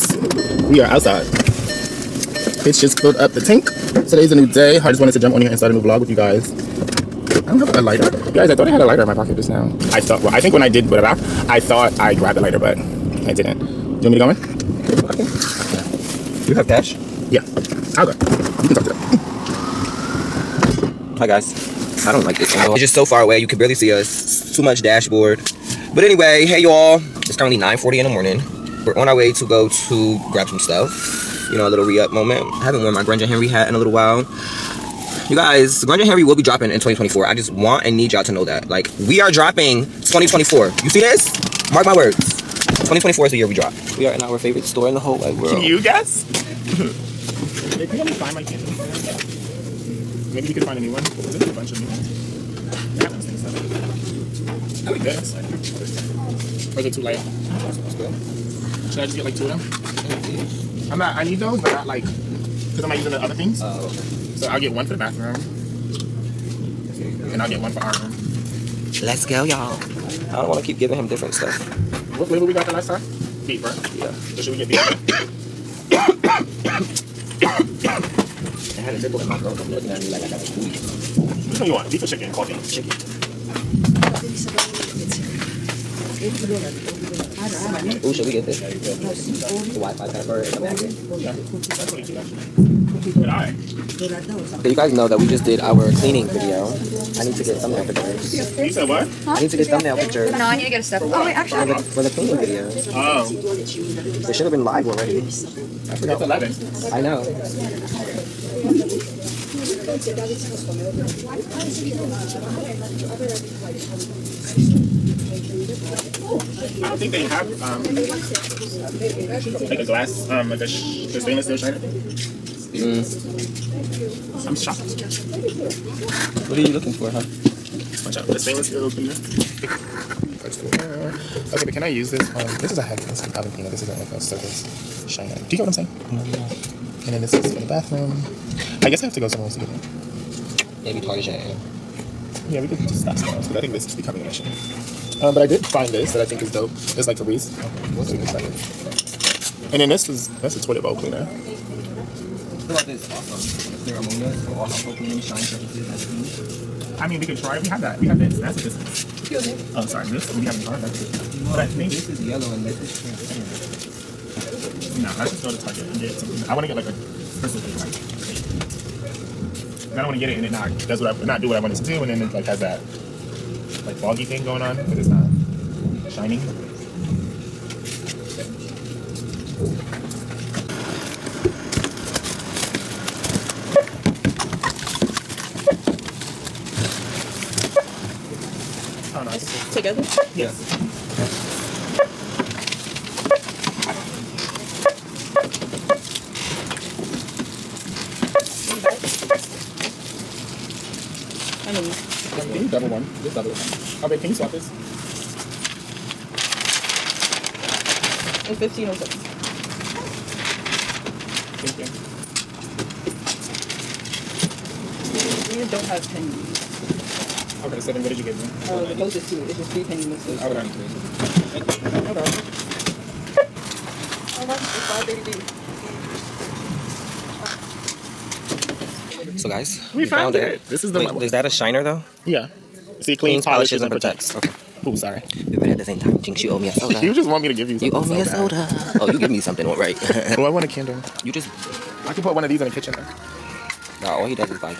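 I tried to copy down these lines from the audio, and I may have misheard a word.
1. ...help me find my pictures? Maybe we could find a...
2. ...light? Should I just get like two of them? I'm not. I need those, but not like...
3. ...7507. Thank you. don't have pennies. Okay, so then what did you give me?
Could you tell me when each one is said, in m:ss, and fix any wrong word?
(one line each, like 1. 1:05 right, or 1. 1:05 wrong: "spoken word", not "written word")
1. 0:47 wrong: "candles", not "pictures"
2. 0:57 right
3. 3:28 wrong: "1507", not "7507".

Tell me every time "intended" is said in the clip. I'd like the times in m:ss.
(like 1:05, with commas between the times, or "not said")
not said.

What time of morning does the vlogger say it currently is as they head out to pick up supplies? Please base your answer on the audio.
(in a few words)
9:40.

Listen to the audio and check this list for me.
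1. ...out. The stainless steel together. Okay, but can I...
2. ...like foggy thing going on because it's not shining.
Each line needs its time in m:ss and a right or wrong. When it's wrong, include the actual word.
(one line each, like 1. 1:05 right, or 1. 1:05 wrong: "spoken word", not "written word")
1. 2:08 wrong: "cleaner", not "together"
2. 2:53 right.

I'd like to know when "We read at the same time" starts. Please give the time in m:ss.
3:55.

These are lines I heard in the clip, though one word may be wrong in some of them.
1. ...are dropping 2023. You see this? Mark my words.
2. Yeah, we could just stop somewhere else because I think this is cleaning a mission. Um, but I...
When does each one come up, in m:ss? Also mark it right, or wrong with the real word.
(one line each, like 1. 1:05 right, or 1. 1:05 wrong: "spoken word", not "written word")
1. 0:39 wrong: "2024", not "2023"
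2. 2:22 wrong: "becoming", not "cleaning".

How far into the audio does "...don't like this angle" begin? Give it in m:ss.
0:22.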